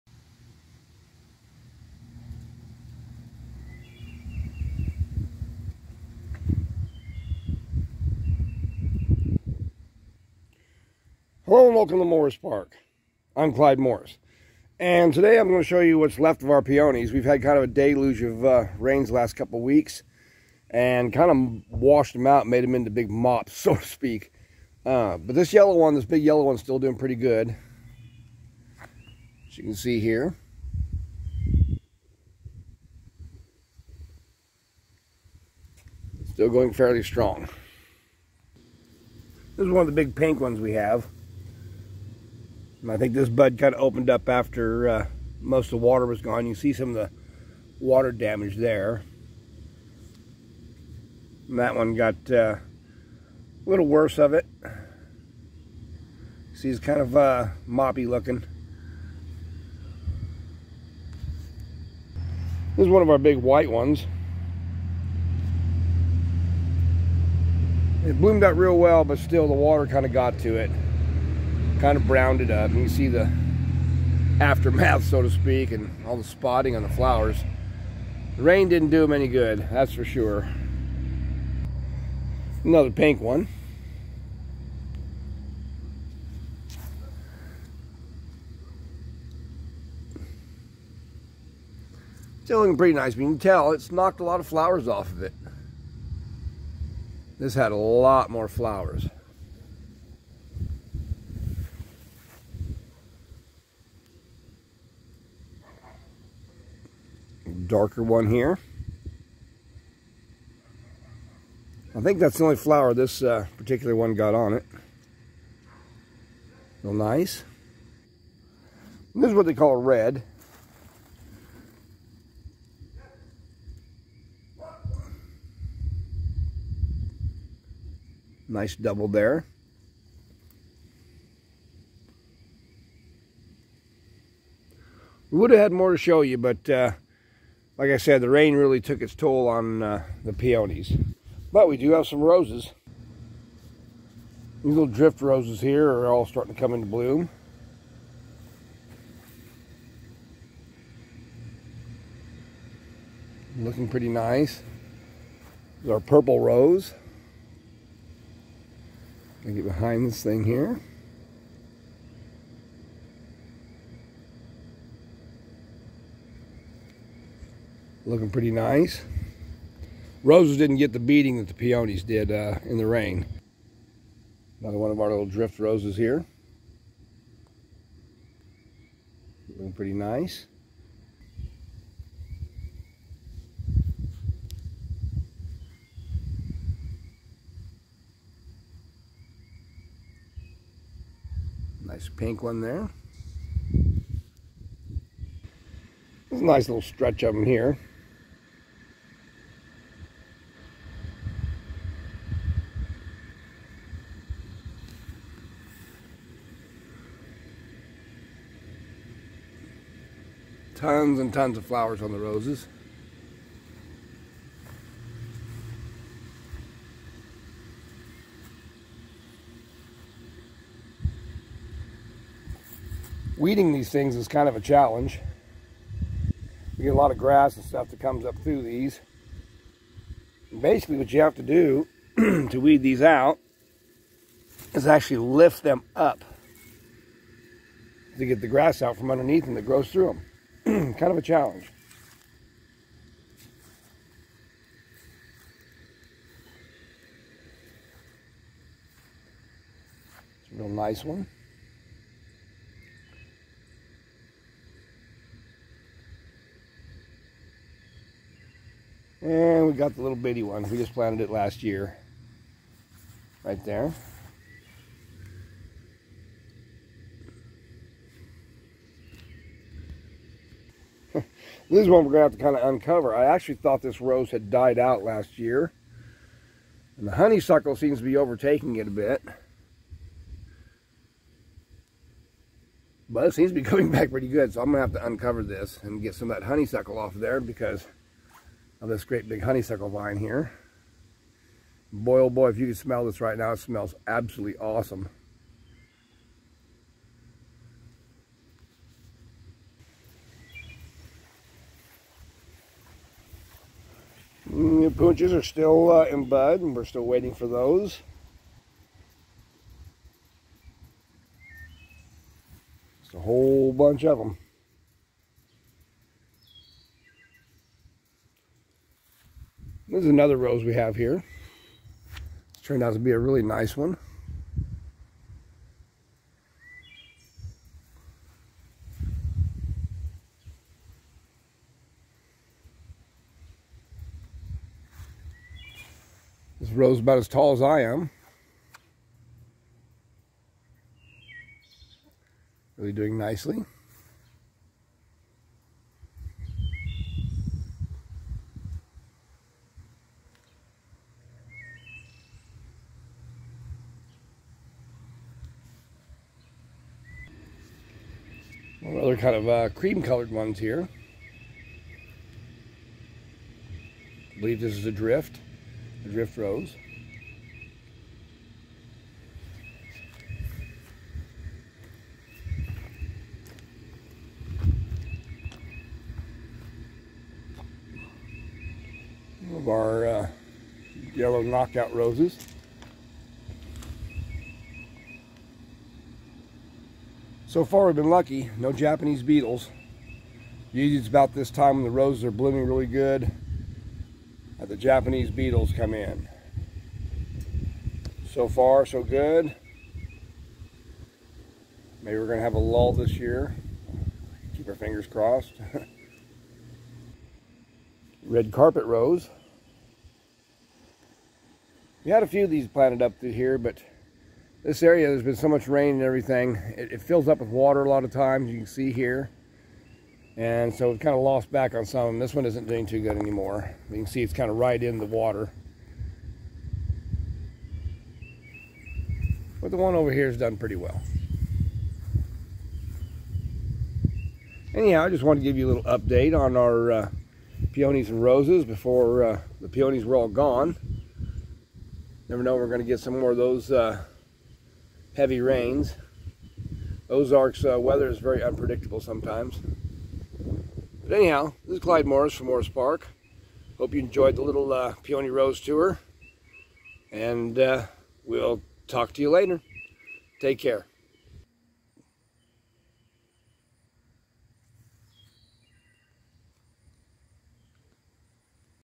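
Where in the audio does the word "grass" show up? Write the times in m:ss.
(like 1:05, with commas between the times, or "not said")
3:47, 3:58.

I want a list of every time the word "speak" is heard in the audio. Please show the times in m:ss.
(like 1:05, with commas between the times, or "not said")
0:23, 1:15.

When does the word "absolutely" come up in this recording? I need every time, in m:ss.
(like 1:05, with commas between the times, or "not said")
4:54.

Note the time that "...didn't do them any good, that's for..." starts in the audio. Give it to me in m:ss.
1:18.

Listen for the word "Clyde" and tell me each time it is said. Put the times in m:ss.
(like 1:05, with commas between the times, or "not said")
0:13, 7:31.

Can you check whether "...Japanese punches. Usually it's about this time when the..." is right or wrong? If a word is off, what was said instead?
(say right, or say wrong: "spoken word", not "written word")
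wrong: "beetles", not "punches".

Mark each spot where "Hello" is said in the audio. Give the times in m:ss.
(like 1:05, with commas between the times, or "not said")
0:11.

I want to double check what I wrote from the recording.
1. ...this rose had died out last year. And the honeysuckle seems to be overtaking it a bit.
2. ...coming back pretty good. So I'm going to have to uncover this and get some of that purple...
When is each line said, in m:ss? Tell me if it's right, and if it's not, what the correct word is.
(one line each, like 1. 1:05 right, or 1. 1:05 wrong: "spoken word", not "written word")
1. 4:33 right
2. 4:43 wrong: "honeysuckle", not "purple".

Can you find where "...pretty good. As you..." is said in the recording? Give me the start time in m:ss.
0:26.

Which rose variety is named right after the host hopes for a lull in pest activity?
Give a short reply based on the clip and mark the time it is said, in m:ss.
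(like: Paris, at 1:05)
Red carpet rose, at 6:48.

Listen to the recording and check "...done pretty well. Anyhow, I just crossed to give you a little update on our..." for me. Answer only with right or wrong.
wrong.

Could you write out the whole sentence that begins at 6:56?
It, it fills up with water a lot of times, you can see here.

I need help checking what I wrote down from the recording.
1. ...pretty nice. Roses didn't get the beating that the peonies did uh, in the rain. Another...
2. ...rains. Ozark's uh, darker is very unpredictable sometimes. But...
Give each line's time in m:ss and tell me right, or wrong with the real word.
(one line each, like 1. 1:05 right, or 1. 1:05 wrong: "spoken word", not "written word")
1. 2:48 right
2. 7:25 wrong: "weather", not "darker".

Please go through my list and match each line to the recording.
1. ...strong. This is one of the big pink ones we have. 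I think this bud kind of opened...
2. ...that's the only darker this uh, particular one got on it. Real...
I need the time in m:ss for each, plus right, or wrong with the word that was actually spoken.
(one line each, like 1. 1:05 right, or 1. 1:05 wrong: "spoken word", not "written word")
1. 0:37 right
2. 1:52 wrong: "flower", not "darker".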